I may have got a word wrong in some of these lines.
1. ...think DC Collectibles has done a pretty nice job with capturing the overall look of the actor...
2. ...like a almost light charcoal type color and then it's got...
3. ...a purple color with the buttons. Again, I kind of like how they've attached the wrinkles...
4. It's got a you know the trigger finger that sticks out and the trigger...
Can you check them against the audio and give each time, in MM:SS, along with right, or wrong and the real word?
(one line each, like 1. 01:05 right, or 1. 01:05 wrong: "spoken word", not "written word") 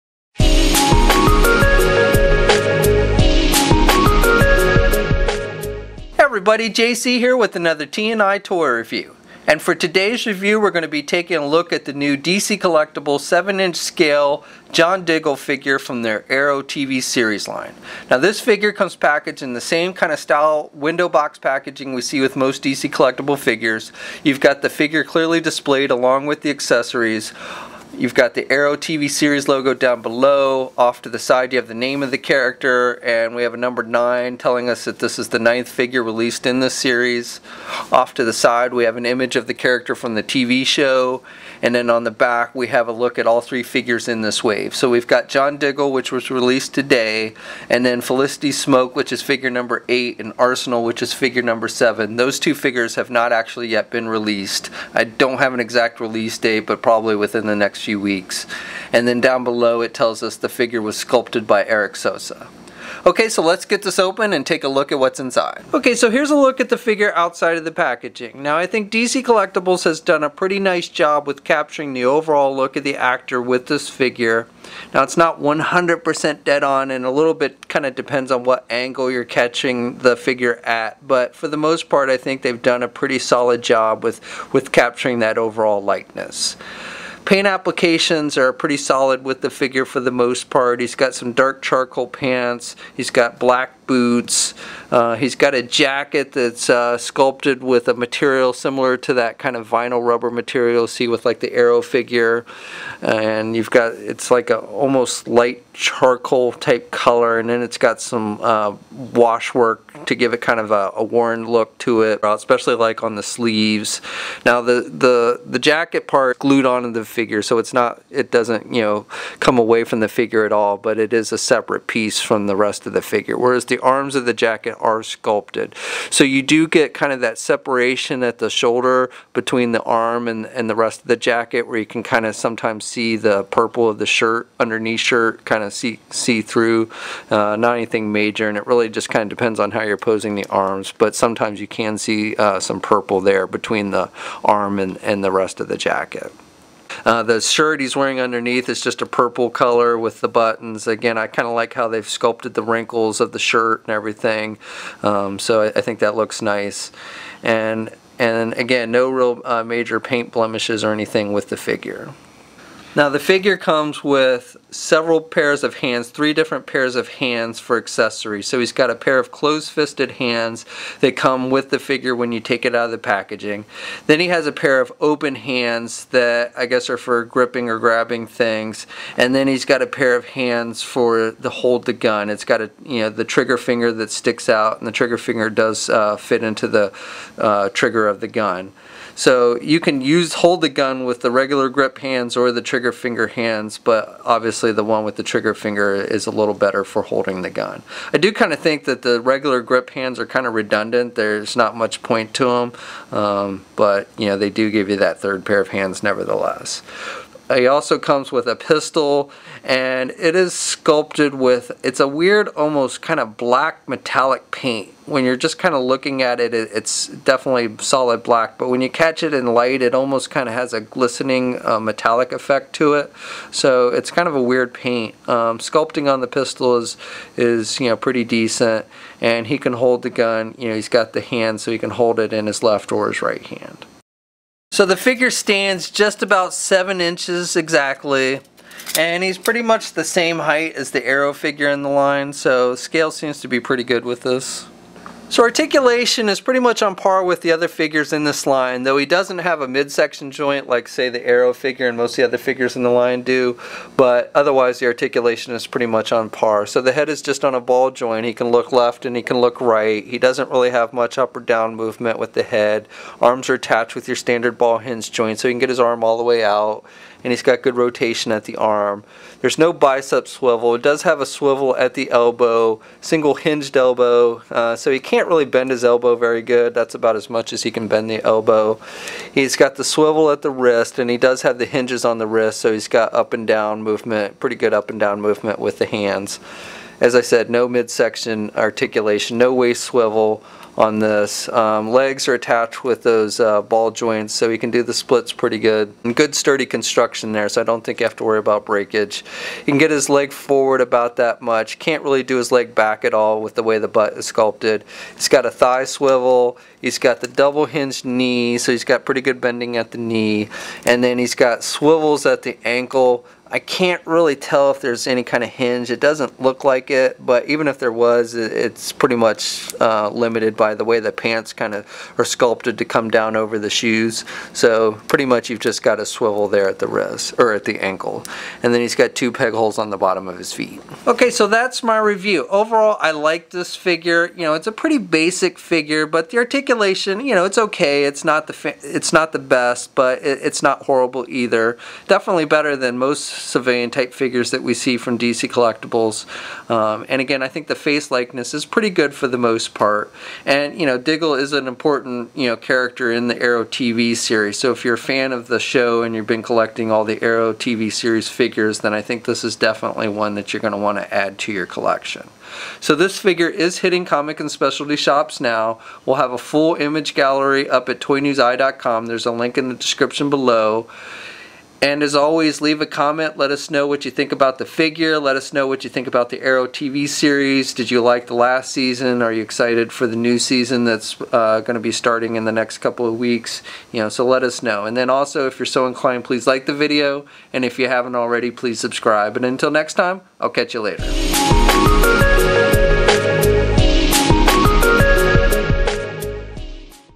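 1. 01:08 right
2. 01:44 right
3. 02:29 wrong: "sculpted", not "attached"
4. 03:02 right.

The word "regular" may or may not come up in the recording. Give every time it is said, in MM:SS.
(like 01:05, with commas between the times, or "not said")
03:11, 03:19.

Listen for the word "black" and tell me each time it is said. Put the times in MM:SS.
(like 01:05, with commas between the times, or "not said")
01:33, 03:33, 03:38.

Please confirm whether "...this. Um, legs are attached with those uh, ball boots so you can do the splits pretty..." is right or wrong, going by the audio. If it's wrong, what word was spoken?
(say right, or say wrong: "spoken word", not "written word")
wrong: "joints", not "boots".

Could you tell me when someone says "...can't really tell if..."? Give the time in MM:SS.
05:13.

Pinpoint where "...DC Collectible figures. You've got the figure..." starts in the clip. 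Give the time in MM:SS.
00:22.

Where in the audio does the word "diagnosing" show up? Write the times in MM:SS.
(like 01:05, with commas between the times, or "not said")
not said.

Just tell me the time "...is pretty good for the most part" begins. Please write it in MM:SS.
05:48.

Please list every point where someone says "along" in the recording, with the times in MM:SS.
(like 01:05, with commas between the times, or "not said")
00:25.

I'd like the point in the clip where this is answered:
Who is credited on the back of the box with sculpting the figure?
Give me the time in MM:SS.
01:01.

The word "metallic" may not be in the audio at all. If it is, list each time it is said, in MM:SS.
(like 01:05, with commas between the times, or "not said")
03:33, 03:41.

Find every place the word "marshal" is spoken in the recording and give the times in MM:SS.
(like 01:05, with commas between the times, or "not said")
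not said.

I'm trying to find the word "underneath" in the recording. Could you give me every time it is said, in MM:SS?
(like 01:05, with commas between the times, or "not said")
02:14, 02:28.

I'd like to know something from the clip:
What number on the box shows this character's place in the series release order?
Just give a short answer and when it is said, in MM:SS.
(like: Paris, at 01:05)
9, at 00:33.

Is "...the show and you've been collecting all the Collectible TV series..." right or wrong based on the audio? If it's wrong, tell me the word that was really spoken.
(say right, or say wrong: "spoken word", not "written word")
wrong: "Arrow", not "Collectible".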